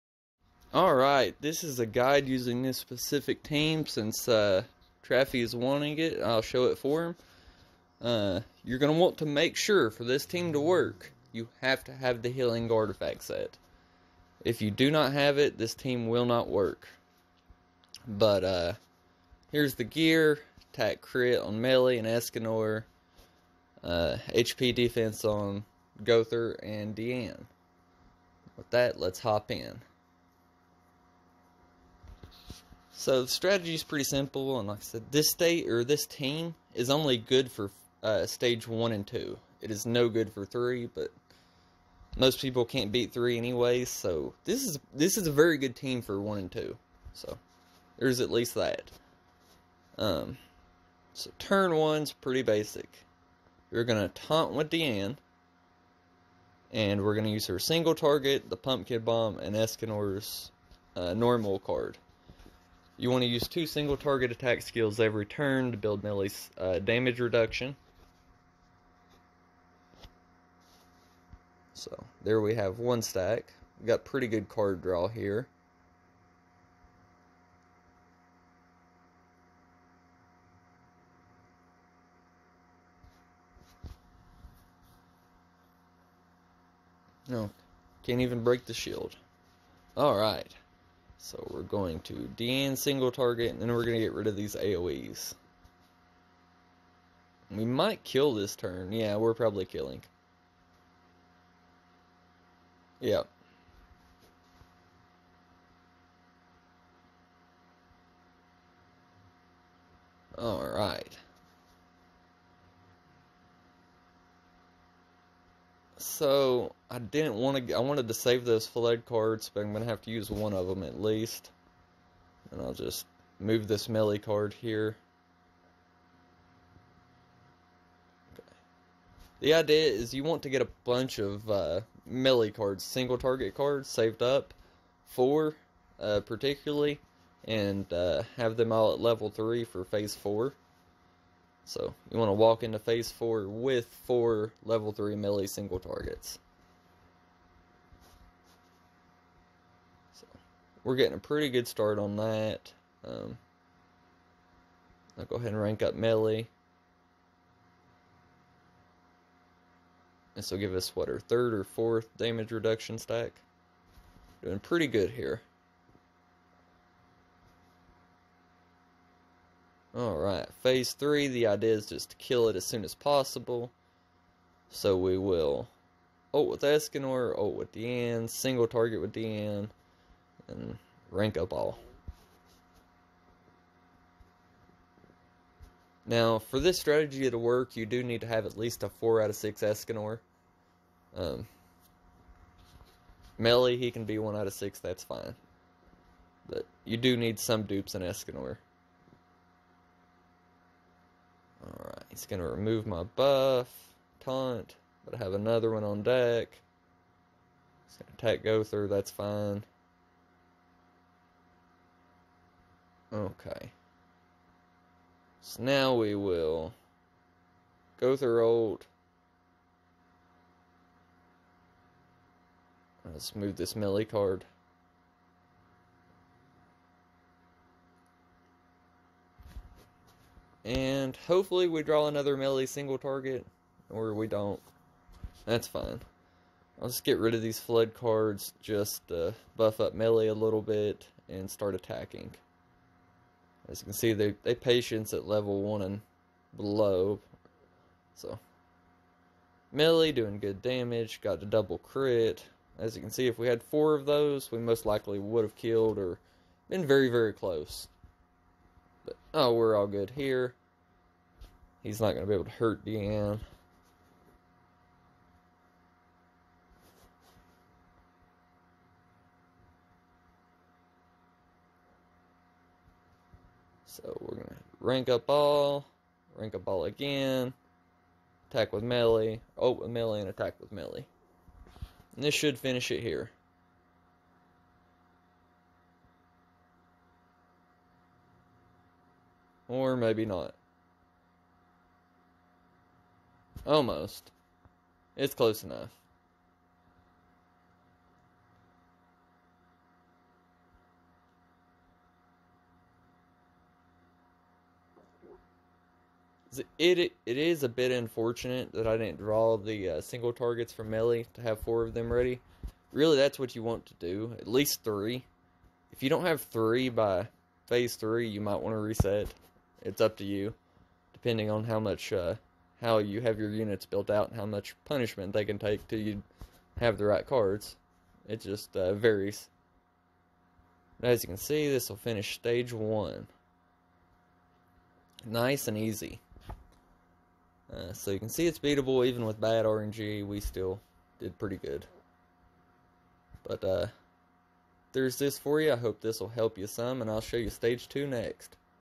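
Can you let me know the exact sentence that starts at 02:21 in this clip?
So you want to walk into phase four with four level three Meli single targets.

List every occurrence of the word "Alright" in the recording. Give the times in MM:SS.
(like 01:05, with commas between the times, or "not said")
00:00, 01:50, 02:49.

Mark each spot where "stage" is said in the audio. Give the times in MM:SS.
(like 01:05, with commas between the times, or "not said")
00:38, 05:32, 05:47.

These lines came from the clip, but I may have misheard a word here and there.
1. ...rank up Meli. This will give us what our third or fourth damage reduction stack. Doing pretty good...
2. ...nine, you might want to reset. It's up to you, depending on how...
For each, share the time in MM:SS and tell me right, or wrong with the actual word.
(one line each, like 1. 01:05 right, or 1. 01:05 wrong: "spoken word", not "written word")
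1. 02:35 right
2. 05:17 wrong: "three", not "nine".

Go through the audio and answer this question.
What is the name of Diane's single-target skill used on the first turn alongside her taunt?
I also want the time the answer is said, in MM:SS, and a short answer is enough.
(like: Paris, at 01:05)
Pumpkin Bomb, at 00:58.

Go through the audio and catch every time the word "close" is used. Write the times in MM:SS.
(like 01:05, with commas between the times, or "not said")
04:17, 04:55.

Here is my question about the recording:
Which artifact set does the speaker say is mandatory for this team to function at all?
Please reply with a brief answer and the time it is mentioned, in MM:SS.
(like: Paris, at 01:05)
Healing artifact set, at 00:12.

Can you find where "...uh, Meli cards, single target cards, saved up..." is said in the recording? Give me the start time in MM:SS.
02:11.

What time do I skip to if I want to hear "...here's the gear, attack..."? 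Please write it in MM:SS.
00:19.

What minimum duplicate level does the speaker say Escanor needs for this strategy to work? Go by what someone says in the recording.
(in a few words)
4 out of 6.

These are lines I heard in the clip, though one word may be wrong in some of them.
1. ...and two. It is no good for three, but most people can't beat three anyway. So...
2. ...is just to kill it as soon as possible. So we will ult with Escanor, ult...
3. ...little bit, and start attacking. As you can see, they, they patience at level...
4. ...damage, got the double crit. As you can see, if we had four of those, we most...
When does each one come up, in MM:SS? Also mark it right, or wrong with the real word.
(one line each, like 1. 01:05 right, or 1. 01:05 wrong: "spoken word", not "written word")
1. 00:38 right
2. 02:51 right
3. 04:00 right
4. 04:10 right.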